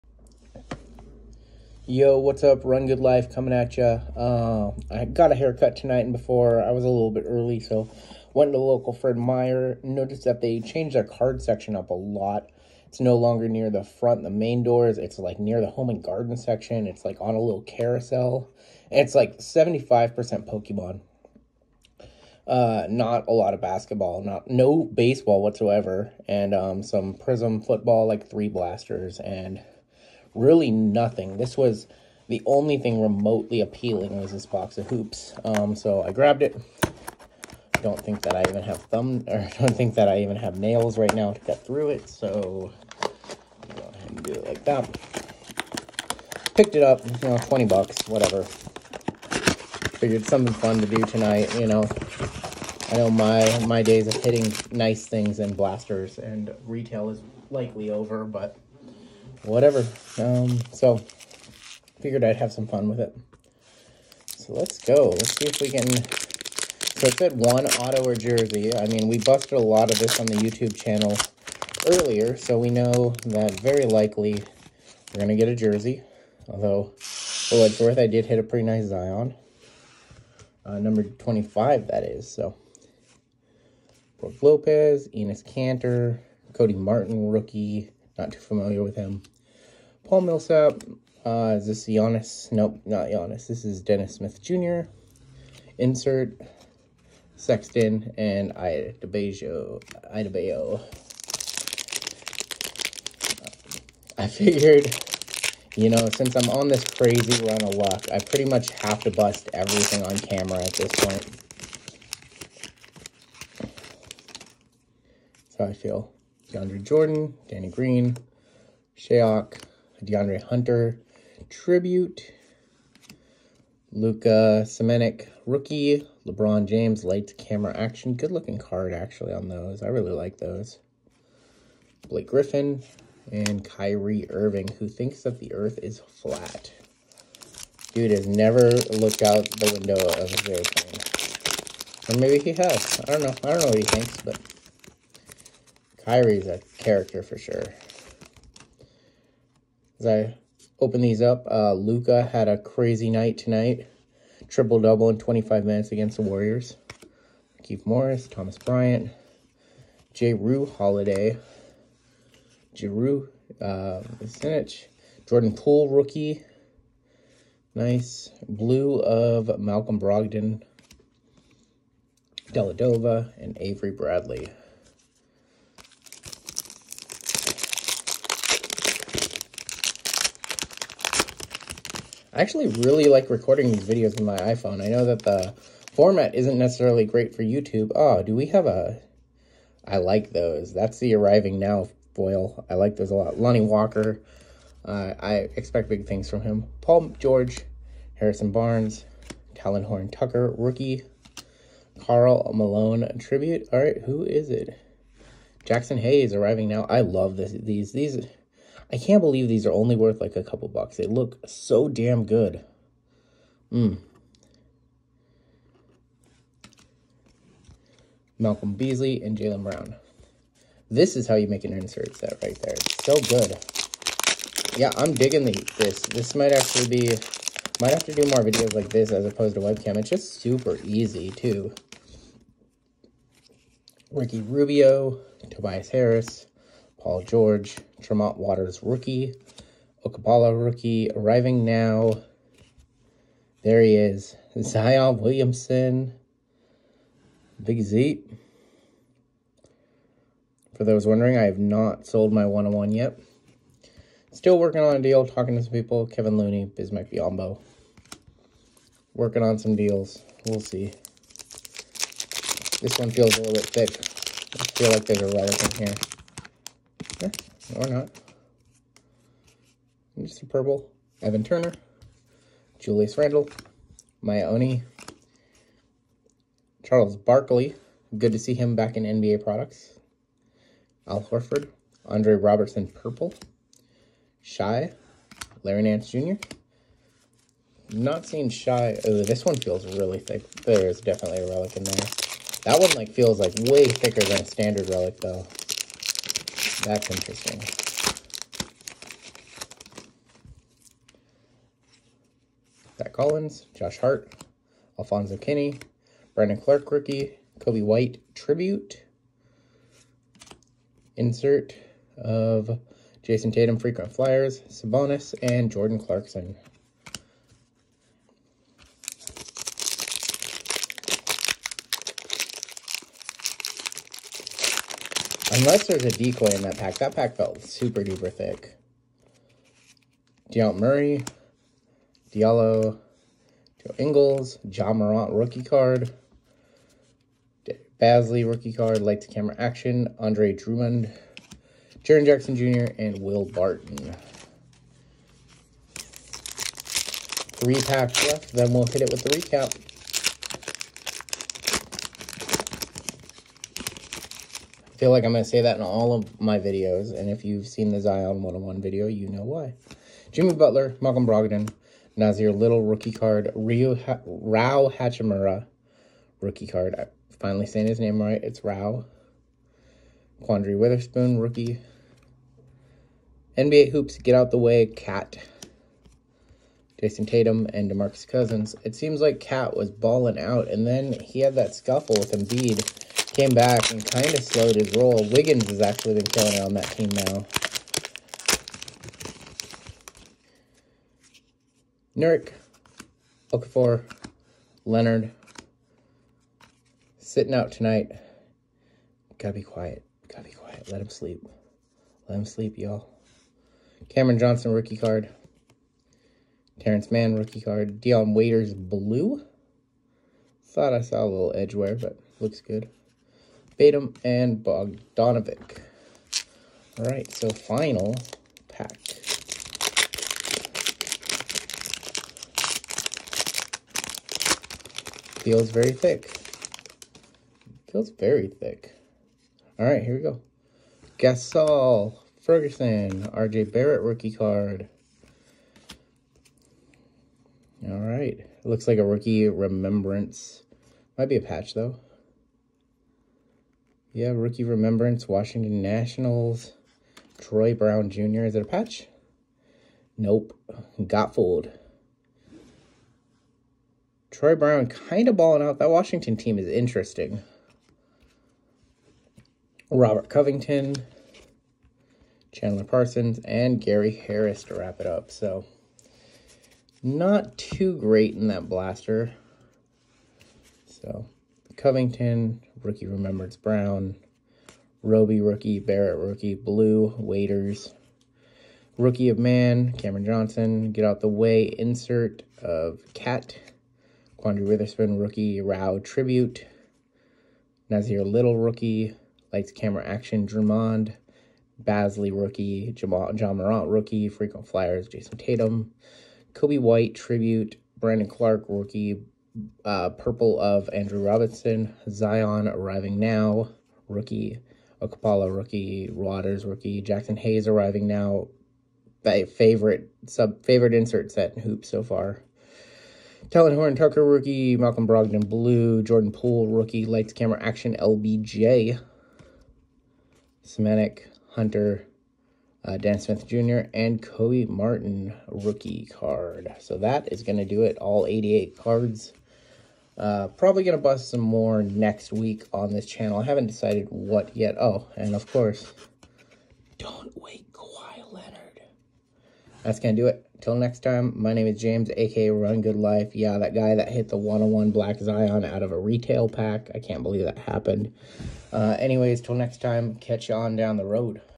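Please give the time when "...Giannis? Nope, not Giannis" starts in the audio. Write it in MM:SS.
01:31.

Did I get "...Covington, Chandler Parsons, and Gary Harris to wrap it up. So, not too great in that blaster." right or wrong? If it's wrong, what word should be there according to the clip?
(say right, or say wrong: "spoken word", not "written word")
right.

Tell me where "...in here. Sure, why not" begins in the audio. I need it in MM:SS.
04:25.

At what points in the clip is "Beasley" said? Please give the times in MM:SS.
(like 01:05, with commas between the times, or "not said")
03:38.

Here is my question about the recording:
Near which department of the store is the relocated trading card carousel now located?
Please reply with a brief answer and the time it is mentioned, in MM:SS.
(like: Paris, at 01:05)
home and garden section, at 00:15.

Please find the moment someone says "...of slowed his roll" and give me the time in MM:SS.
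06:24.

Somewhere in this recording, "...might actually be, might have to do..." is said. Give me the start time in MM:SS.
03:46.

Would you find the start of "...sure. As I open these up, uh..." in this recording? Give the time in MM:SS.
02:27.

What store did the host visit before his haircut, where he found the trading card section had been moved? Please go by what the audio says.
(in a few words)
Fred Meyer.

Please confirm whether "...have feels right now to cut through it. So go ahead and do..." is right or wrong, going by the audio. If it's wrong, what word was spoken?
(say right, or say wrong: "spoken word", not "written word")
wrong: "nails", not "feels".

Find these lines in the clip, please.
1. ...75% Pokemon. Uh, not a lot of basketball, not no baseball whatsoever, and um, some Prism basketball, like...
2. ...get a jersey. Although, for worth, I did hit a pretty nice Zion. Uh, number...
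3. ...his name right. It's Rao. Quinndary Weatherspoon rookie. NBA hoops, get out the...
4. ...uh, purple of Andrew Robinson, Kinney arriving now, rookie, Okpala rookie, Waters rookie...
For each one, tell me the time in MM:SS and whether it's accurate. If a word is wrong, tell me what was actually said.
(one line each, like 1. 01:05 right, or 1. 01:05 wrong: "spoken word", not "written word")
1. 00:19 wrong: "football", not "basketball"
2. 01:15 right
3. 06:07 right
4. 08:19 wrong: "Zion", not "Kinney".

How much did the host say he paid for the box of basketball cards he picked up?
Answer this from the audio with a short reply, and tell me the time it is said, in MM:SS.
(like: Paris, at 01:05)
20 bucks, at 00:47.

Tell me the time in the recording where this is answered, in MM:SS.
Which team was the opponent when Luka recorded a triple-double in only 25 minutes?
02:36.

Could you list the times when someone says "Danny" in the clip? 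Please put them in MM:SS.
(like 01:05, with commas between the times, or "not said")
01:57.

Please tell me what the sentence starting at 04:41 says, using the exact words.
Al Horford, Andre Roberson Purple, Shai, Larry Nance Jr.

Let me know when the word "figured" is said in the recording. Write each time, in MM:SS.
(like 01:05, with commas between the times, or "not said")
00:48, 01:02, 01:44.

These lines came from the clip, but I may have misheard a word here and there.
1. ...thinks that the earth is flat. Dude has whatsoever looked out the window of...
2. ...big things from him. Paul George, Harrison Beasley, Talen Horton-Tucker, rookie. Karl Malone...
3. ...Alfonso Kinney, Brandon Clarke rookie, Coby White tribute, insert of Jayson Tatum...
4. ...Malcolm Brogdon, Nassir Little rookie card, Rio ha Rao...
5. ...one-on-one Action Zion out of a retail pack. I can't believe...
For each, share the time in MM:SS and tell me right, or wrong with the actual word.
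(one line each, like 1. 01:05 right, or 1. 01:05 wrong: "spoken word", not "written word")
1. 02:14 wrong: "never", not "whatsoever"
2. 03:15 wrong: "Barnes", not "Beasley"
3. 05:04 right
4. 06:01 right
5. 09:04 wrong: "Black", not "Action".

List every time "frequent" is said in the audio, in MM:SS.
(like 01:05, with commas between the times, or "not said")
05:13, 08:14.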